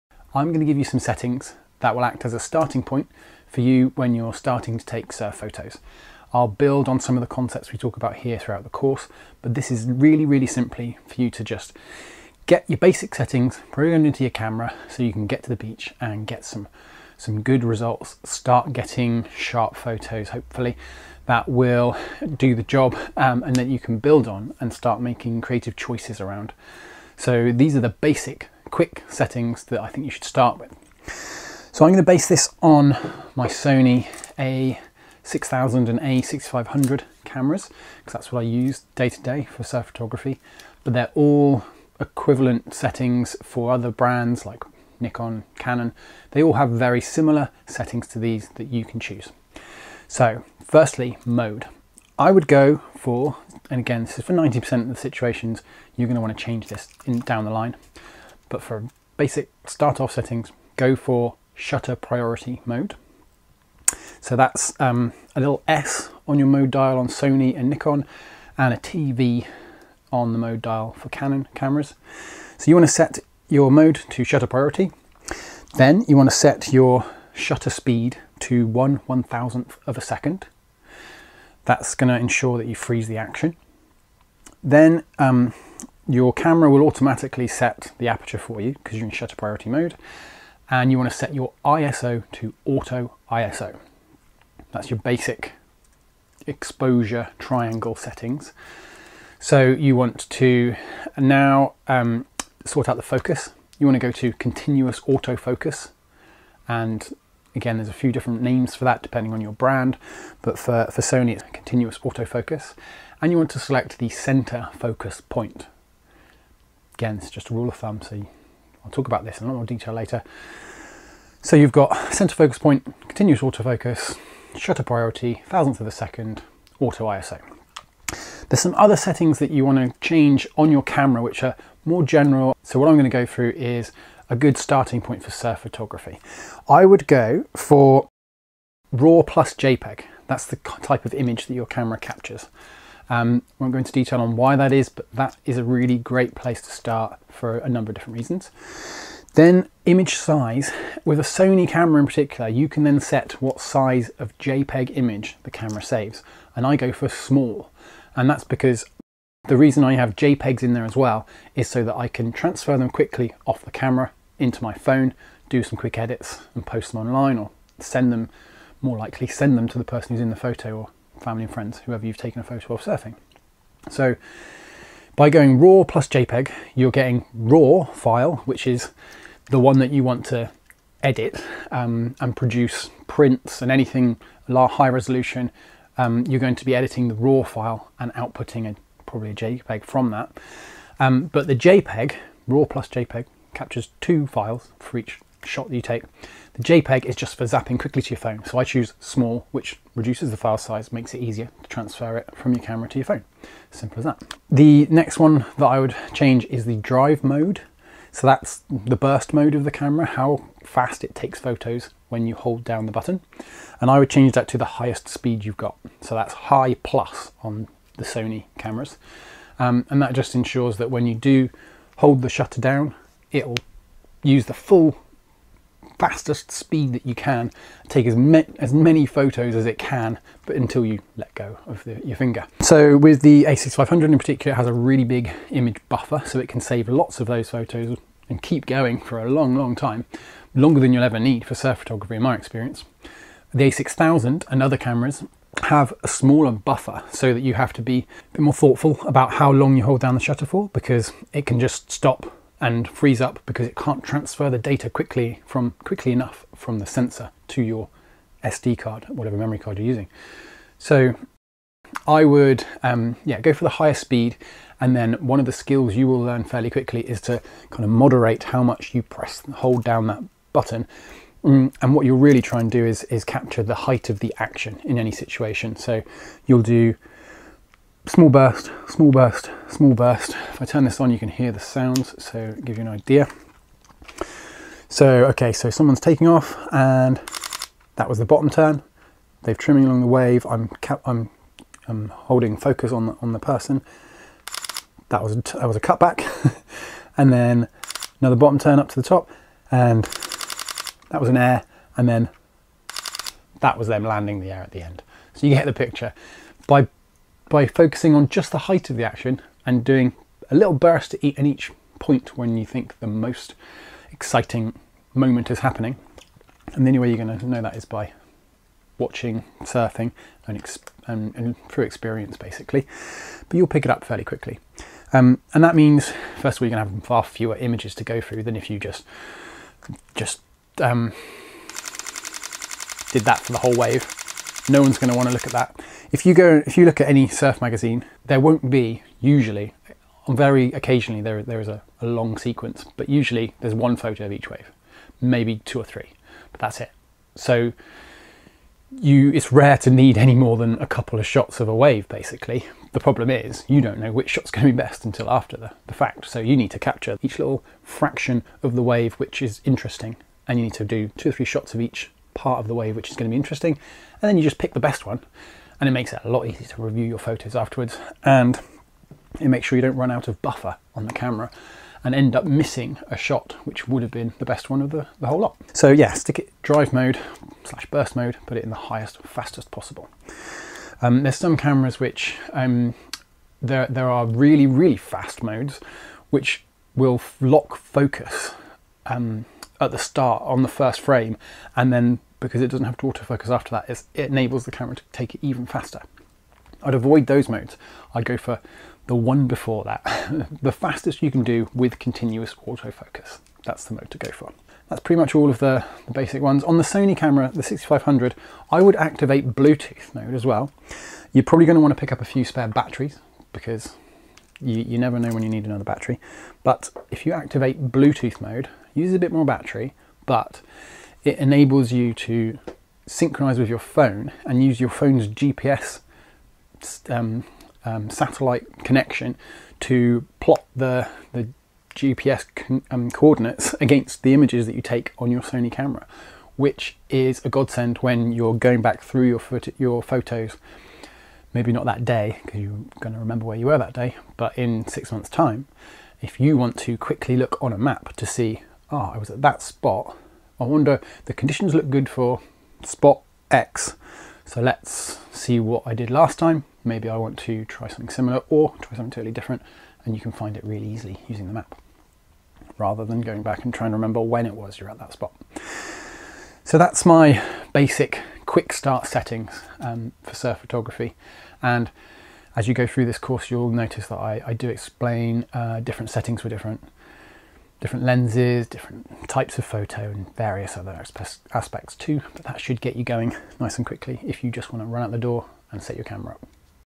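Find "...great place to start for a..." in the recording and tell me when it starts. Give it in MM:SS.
02:25.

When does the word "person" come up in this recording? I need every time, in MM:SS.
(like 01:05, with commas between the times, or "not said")
02:49, 04:53.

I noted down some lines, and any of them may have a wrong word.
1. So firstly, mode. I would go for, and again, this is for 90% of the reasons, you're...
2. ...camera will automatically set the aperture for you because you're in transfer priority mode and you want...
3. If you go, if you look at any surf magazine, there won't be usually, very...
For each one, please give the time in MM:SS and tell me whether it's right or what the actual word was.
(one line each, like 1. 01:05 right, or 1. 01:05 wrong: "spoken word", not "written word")
1. 00:50 wrong: "situations", not "reasons"
2. 01:26 wrong: "shutter", not "transfer"
3. 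05:36 right.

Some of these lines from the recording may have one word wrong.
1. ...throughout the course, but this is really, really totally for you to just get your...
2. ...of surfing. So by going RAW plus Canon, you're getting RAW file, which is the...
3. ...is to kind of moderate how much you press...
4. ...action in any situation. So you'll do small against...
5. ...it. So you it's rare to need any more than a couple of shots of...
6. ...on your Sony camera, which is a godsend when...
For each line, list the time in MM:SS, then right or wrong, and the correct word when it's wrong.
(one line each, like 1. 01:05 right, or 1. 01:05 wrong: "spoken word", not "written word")
1. 00:08 wrong: "simply", not "totally"
2. 02:52 wrong: "JPEG", not "Canon"
3. 04:27 right
4. 04:34 wrong: "burst", not "against"
5. 05:46 right
6. 07:15 right.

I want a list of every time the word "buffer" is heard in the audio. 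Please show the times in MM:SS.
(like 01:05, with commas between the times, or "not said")
03:55, 04:06, 06:10.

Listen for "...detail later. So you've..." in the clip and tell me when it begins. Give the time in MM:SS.
01:59.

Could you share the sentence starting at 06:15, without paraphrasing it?
So yeah, stick it drive mode slash burst mode, put it in the highest, fastest possible.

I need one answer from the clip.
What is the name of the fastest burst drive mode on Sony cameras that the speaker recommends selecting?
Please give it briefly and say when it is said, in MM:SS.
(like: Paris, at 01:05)
High plus, at 03:36.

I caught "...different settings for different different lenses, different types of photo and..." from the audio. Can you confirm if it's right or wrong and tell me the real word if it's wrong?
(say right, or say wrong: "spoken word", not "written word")
right.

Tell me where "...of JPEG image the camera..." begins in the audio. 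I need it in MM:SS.
02:34.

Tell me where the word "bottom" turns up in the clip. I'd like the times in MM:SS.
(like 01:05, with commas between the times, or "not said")
04:48, 04:58.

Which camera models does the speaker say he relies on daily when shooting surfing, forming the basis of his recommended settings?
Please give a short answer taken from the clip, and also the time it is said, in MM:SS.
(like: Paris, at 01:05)
Sony A6000 and A6500, at 00:33.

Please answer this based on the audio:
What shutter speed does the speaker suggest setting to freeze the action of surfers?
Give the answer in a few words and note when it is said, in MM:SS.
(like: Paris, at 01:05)
1/1000 of a second, at 01:18.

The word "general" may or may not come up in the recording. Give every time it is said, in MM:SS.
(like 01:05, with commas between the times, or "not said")
02:12.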